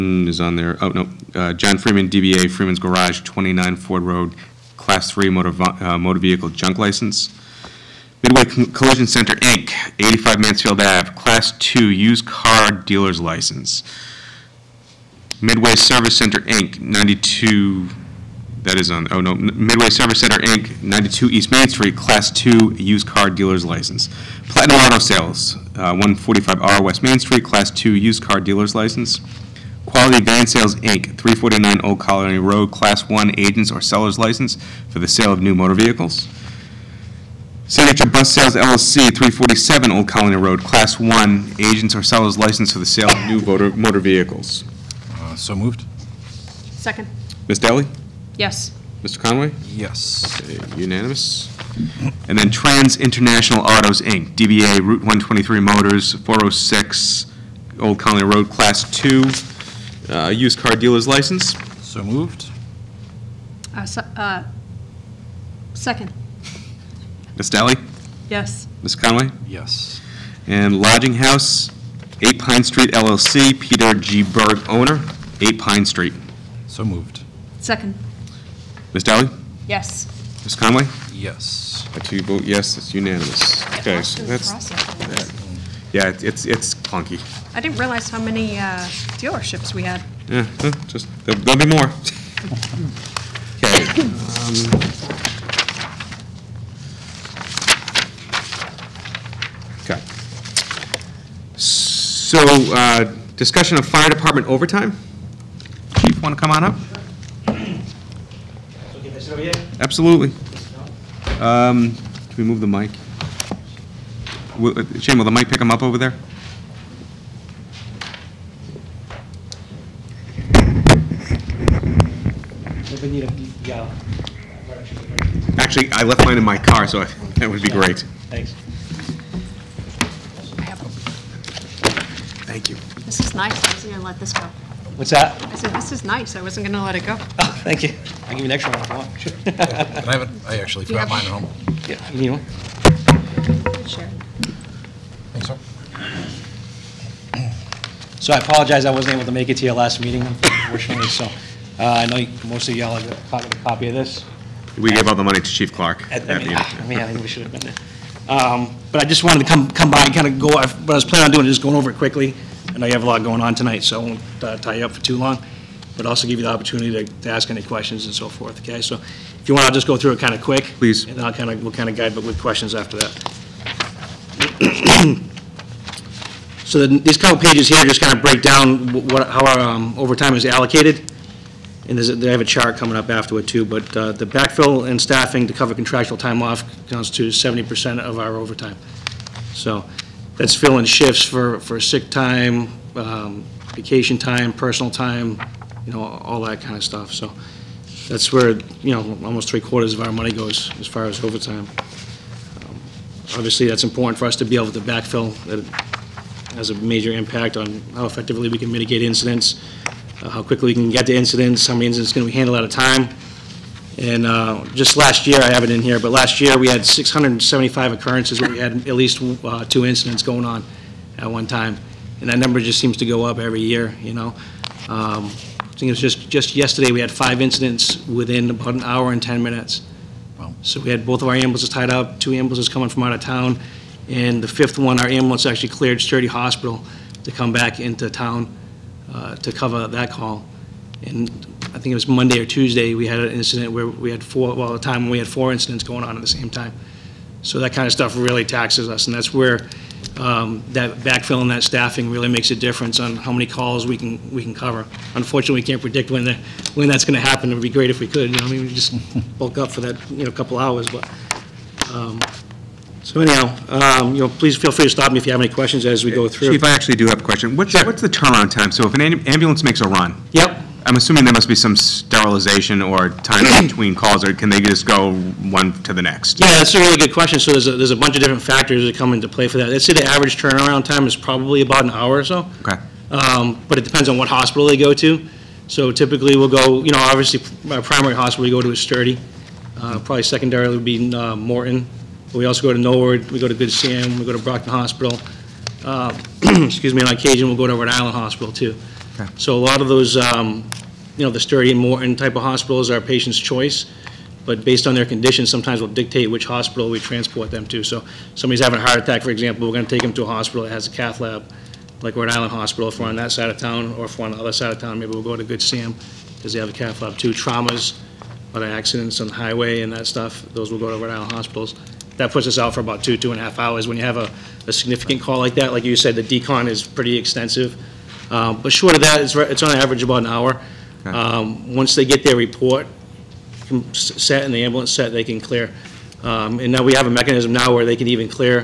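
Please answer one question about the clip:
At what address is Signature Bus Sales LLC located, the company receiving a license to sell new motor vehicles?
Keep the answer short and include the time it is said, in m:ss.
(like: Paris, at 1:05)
347 Old Colony Road, at 0:39.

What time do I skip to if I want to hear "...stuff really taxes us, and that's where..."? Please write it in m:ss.
4:07.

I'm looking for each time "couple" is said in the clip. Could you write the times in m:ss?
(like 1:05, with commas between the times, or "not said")
2:57, 4:20.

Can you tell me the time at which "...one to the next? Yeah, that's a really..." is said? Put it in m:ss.
4:35.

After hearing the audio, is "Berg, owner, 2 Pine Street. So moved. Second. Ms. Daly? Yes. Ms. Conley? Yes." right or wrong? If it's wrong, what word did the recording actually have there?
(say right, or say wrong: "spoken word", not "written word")
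wrong: "8", not "2".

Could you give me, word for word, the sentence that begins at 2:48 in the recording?
So if you want, I'll just go through it kind of quick.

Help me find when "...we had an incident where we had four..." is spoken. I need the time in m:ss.
4:02.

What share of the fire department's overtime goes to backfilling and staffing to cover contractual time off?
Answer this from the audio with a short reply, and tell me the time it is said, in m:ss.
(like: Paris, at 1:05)
70%, at 3:07.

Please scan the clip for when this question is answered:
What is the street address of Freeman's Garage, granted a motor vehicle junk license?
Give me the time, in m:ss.
0:03.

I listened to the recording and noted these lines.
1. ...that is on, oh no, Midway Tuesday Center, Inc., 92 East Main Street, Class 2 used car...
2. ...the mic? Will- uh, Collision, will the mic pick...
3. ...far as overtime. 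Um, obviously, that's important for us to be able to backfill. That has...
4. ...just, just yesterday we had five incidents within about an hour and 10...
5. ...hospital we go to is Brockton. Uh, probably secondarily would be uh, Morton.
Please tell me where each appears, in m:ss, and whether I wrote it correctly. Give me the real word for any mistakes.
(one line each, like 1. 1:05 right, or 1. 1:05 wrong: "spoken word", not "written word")
1. 0:18 wrong: "Service", not "Tuesday"
2. 1:52 wrong: "Shane", not "Collision"
3. 3:20 right
4. 3:45 right
5. 4:48 wrong: "Sturdy", not "Brockton".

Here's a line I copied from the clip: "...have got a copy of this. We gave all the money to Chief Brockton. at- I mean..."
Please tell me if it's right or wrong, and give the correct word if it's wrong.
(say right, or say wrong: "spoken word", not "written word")
wrong: "Clark", not "Brockton".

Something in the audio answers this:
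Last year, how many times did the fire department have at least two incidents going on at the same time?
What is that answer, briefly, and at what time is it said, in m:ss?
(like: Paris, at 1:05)
675, at 3:36.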